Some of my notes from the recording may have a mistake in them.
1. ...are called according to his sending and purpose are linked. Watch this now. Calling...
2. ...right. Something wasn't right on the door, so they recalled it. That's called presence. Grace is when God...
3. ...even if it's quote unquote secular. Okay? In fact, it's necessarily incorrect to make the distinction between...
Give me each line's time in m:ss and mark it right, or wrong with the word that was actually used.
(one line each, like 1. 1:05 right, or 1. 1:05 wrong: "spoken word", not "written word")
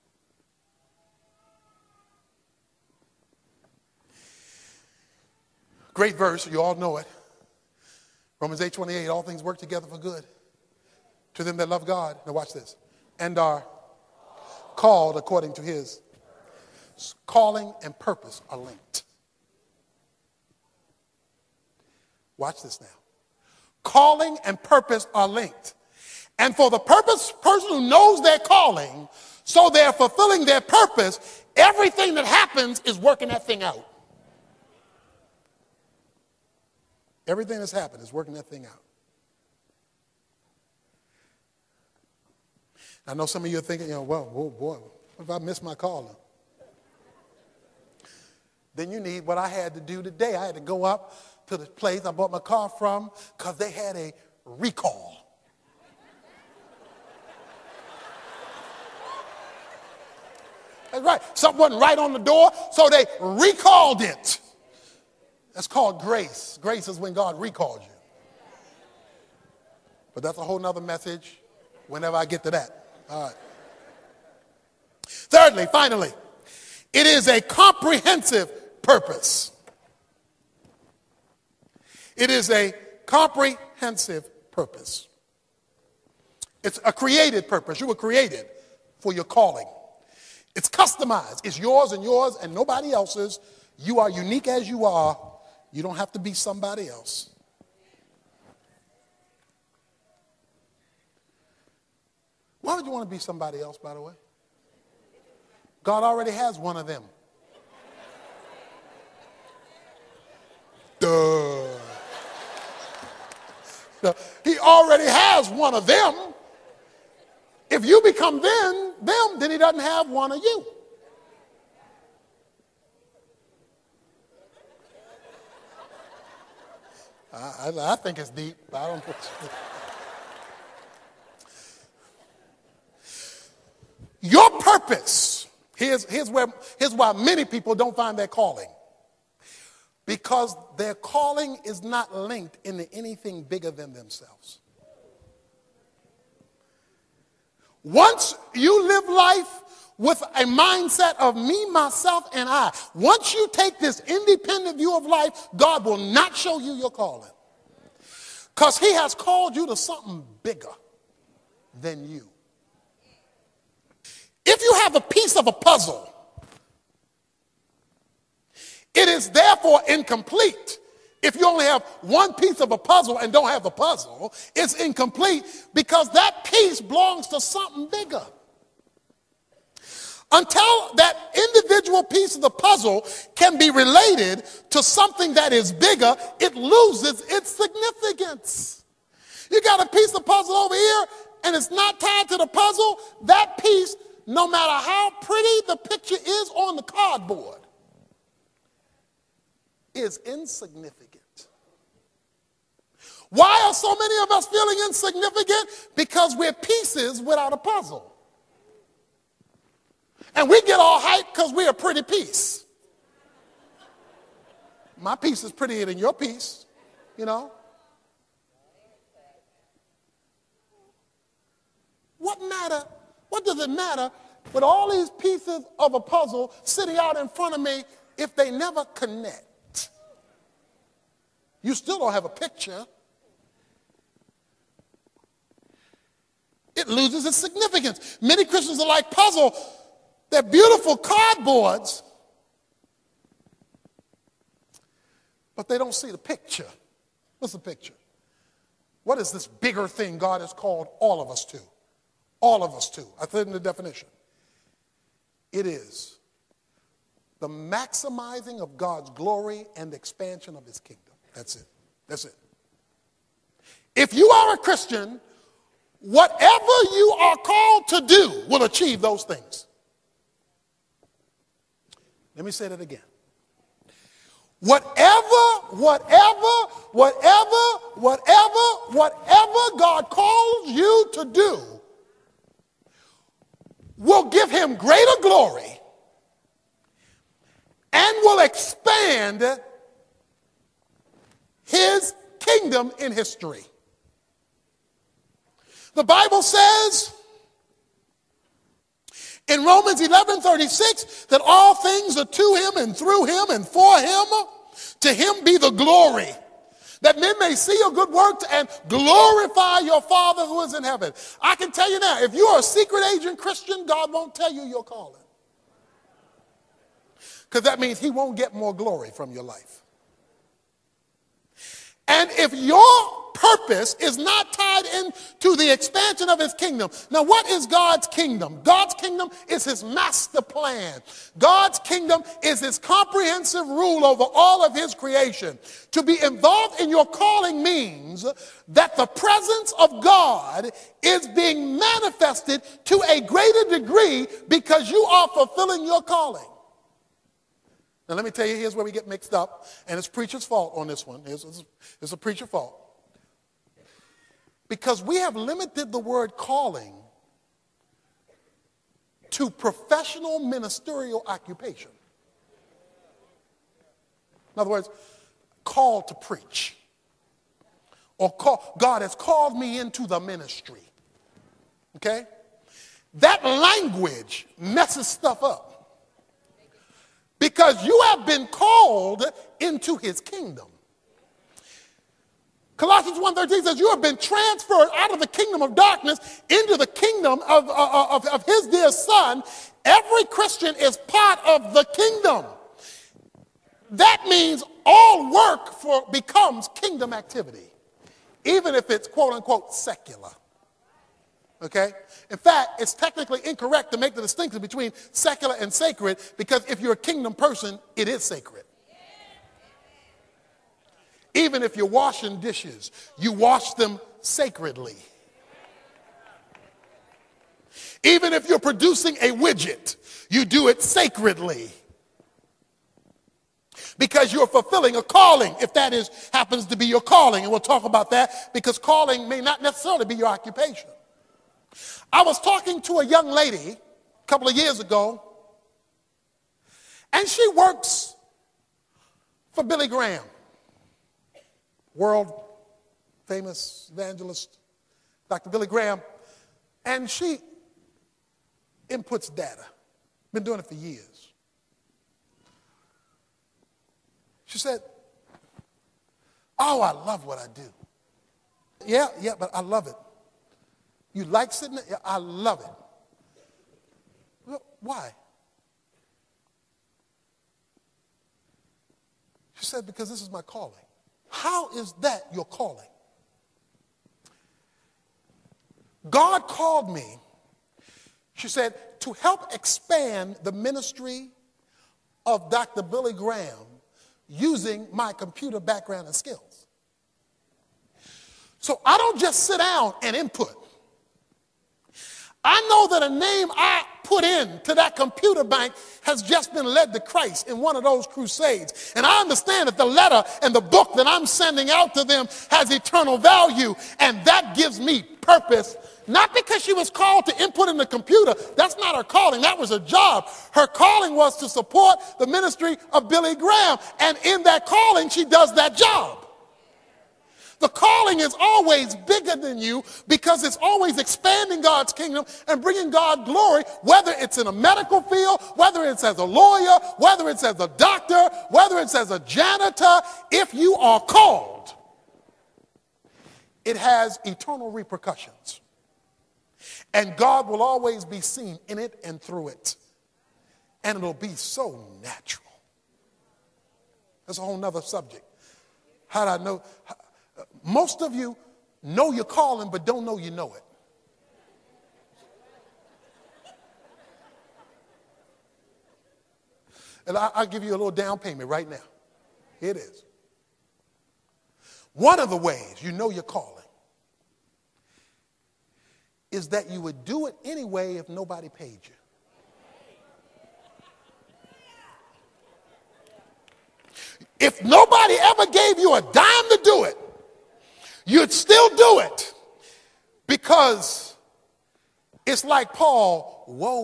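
1. 0:13 wrong: "calling", not "sending"
2. 1:01 wrong: "grace", not "presence"
3. 6:38 wrong: "technically", not "necessarily".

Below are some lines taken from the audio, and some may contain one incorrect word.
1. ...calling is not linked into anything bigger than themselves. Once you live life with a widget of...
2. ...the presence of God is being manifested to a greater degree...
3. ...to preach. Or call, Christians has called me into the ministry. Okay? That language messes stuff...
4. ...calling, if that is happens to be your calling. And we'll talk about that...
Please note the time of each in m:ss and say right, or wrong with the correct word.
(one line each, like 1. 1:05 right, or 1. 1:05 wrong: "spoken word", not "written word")
1. 2:20 wrong: "mindset", not "widget"
2. 5:38 right
3. 6:06 wrong: "God", not "Christians"
4. 7:05 right.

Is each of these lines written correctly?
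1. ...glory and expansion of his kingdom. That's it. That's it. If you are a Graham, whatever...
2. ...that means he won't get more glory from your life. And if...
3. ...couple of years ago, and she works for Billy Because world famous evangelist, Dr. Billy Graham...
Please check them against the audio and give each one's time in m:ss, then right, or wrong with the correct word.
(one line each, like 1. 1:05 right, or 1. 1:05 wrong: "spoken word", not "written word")
1. 4:19 wrong: "Christian", not "Graham"
2. 5:17 right
3. 7:14 wrong: "Graham", not "Because".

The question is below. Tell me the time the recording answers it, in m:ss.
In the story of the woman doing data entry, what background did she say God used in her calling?
8:05.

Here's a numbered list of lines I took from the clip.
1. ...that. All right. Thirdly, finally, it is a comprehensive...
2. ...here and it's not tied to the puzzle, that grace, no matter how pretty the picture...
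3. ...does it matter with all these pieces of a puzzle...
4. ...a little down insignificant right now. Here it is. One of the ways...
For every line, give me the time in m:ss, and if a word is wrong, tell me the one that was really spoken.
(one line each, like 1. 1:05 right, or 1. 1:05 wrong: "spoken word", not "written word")
1. 1:12 right
2. 3:10 wrong: "piece", not "grace"
3. 3:43 right
4. 9:17 wrong: "payment", not "insignificant".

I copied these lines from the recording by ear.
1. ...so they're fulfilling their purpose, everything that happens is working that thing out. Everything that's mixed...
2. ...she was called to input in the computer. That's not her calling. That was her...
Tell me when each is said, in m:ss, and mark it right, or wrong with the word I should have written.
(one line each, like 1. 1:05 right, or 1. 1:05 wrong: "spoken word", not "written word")
1. 0:29 wrong: "happened", not "mixed"
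2. 8:26 right.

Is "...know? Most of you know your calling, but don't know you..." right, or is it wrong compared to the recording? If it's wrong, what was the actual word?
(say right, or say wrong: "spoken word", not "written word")
right.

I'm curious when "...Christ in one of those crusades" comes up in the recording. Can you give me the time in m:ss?
8:17.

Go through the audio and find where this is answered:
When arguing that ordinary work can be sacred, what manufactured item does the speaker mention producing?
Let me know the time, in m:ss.
6:59.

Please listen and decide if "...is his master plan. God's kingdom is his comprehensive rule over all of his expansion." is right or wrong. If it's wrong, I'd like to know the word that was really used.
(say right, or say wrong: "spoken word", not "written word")
wrong: "creation", not "expansion".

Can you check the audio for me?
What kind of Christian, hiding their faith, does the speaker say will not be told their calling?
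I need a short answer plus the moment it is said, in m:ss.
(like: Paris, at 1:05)
Secret agent Christian, at 5:12.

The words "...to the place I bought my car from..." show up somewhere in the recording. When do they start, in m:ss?
0:51.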